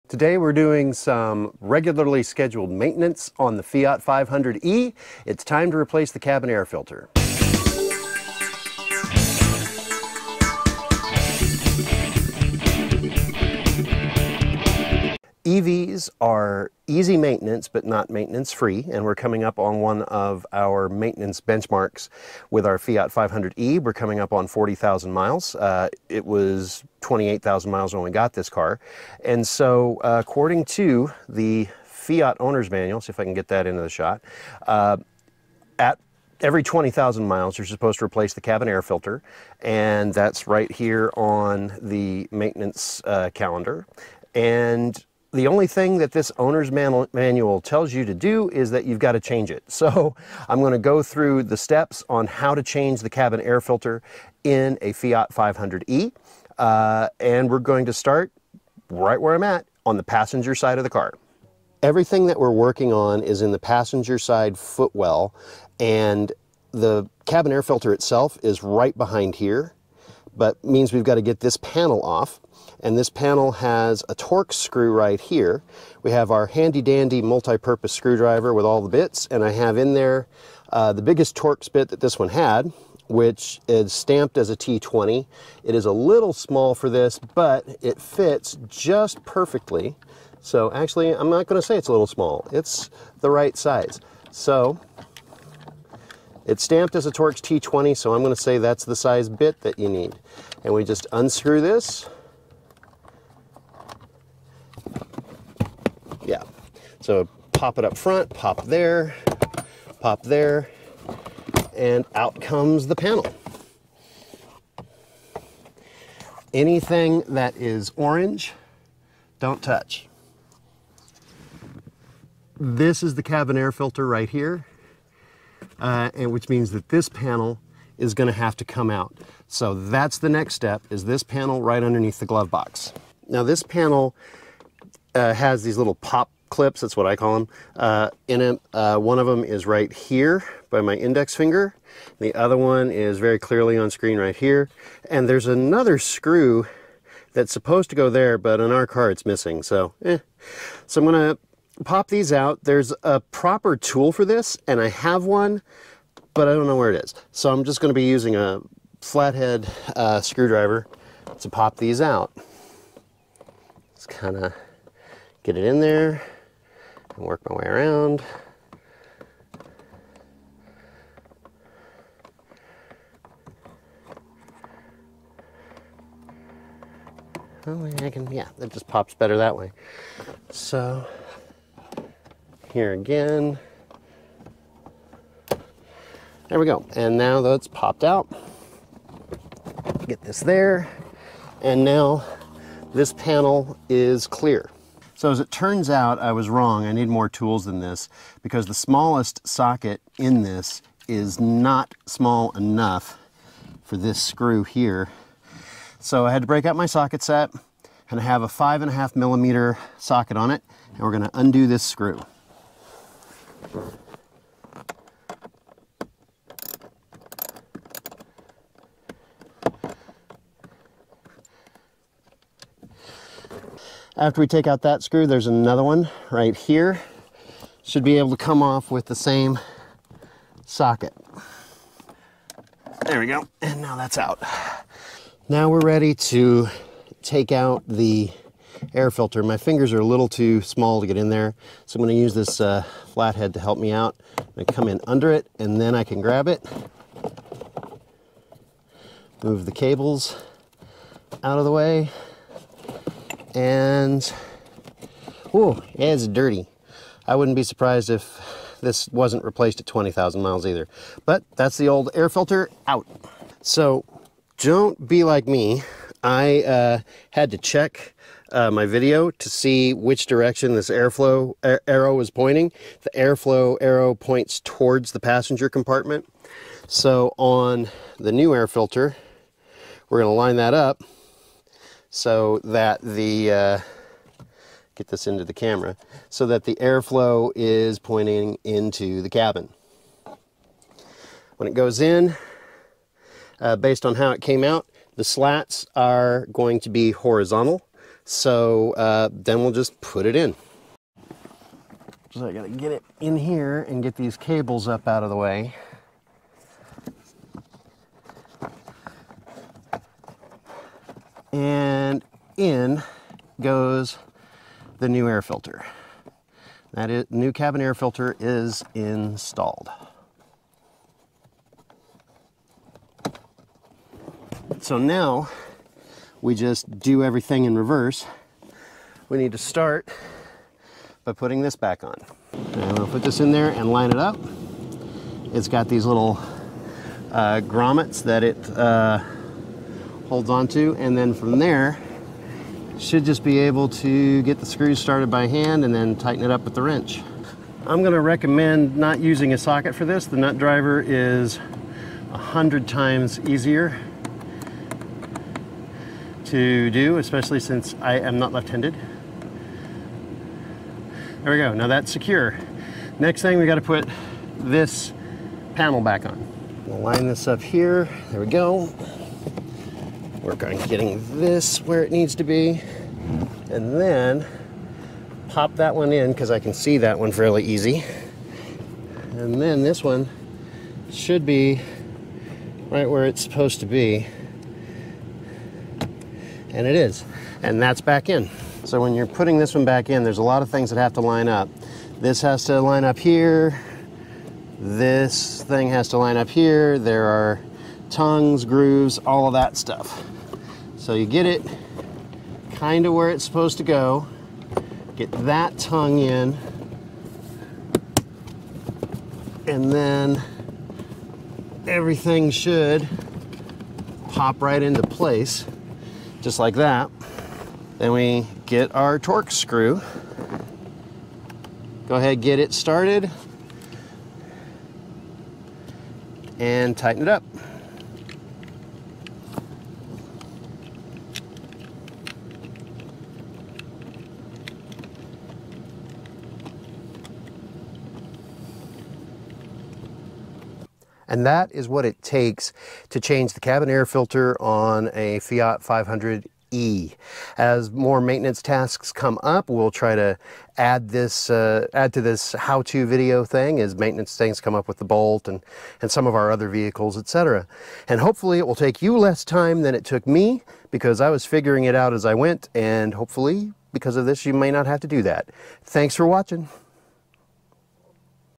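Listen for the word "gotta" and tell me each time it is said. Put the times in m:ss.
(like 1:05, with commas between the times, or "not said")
5:02, 6:03.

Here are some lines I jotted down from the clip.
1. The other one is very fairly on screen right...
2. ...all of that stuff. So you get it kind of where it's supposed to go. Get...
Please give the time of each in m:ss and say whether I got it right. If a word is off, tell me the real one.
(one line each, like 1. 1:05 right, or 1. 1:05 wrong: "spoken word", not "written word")
1. 2:22 wrong: "clearly", not "fairly"
2. 6:39 right.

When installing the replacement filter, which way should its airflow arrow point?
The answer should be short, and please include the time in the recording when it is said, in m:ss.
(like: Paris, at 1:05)
Towards the passenger compartment, at 4:34.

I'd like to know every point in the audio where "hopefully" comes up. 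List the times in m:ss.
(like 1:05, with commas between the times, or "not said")
7:38, 7:43.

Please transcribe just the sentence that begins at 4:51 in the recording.
When it goes in, uh, based on how it came out, the slats are going to be horizontal.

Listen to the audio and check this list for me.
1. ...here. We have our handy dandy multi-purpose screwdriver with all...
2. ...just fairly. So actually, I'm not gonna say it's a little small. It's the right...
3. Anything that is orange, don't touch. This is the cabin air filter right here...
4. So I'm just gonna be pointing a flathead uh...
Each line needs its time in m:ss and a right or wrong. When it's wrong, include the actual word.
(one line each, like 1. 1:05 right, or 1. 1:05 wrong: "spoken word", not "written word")
1. 1:15 right
2. 1:28 wrong: "perfectly", not "fairly"
3. 1:56 right
4. 2:37 wrong: "using", not "pointing".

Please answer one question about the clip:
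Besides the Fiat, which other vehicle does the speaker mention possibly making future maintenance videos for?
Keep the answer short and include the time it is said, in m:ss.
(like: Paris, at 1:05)
Bolt, at 7:35.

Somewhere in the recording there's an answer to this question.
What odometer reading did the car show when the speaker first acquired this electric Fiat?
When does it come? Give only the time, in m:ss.
0:27.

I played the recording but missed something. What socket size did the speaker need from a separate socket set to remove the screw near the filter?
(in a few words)
5.5 millimeter.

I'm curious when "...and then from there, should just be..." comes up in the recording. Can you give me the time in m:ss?
5:40.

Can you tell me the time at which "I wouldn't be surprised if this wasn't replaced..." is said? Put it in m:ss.
4:17.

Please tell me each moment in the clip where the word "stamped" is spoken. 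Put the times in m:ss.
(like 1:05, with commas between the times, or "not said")
1:23, 1:36.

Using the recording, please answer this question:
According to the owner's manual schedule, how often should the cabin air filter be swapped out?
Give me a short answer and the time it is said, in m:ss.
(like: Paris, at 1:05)
Every 20,000 miles, at 0:36.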